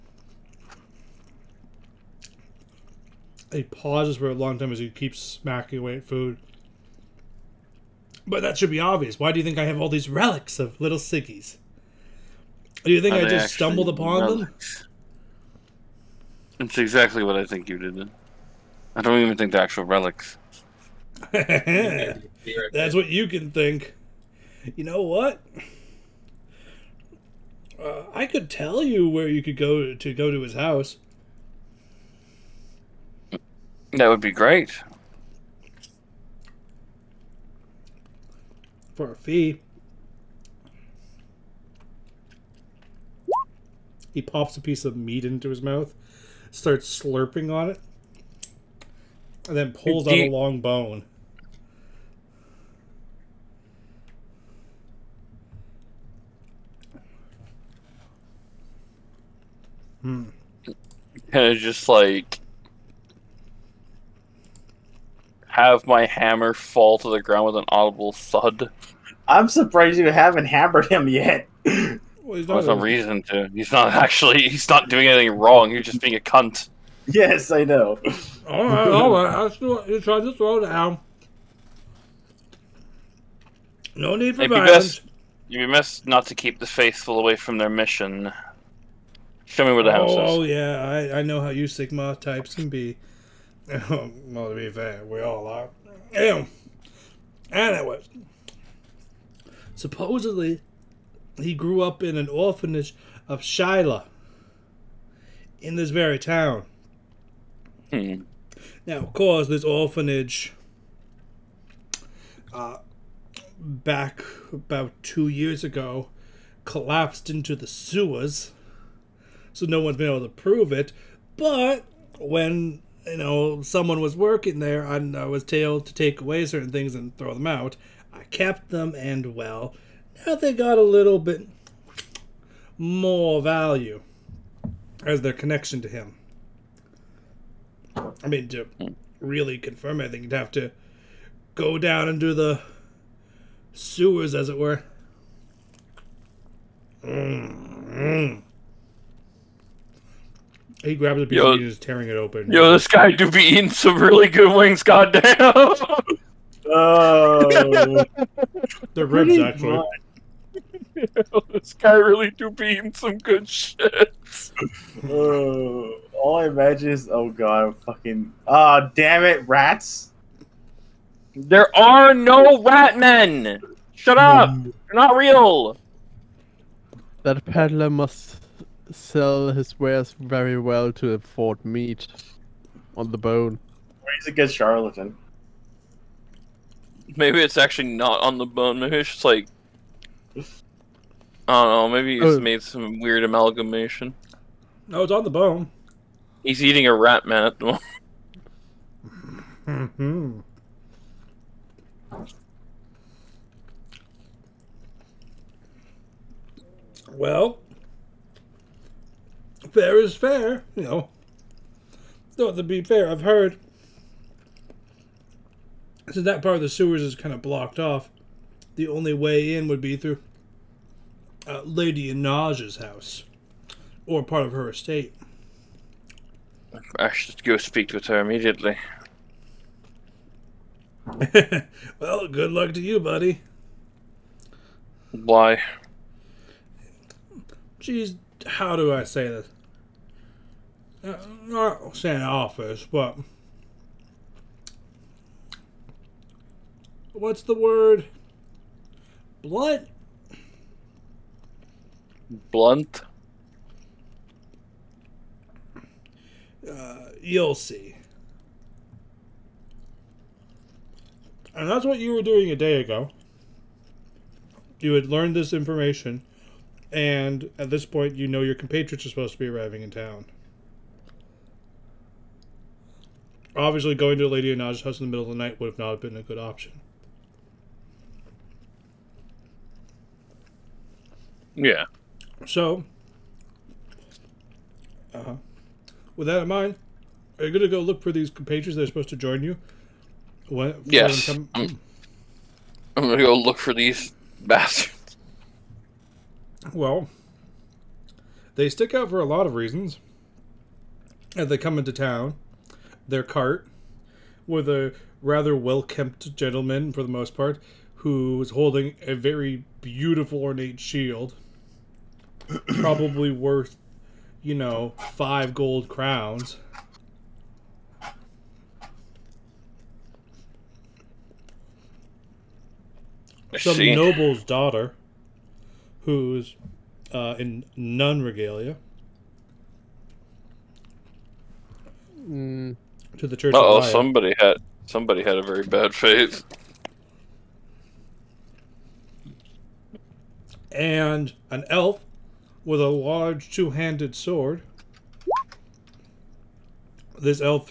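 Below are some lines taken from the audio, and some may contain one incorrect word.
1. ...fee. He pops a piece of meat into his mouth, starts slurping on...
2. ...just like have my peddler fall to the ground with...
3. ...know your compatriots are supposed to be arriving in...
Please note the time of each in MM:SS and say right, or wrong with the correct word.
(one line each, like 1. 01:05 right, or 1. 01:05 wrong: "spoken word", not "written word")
1. 00:39 right
2. 01:01 wrong: "hammer", not "peddler"
3. 04:28 right.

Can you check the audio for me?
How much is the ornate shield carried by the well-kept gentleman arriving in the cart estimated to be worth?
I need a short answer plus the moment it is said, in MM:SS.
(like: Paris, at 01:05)
5 gold crowns, at 05:15.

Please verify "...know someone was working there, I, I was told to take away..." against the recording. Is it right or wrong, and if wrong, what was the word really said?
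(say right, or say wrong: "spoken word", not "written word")
right.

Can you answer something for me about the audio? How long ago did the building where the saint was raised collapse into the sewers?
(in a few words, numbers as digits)
About two years.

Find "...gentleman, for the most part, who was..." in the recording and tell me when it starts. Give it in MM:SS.
05:06.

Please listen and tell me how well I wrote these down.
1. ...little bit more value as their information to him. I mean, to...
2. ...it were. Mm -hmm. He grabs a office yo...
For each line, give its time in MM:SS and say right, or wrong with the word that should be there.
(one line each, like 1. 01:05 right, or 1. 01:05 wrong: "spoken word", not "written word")
1. 02:10 wrong: "connection", not "information"
2. 02:24 wrong: "piece", not "office".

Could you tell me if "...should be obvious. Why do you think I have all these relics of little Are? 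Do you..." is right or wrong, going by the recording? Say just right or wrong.
wrong.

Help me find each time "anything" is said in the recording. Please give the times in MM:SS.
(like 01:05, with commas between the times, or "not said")
01:15, 02:20.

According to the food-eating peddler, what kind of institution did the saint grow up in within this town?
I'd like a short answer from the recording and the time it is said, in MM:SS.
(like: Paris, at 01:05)
Orphanage of Shallya, at 01:42.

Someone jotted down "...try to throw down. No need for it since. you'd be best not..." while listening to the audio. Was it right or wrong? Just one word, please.
wrong.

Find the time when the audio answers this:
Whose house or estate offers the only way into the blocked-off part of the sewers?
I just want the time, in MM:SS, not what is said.
03:41.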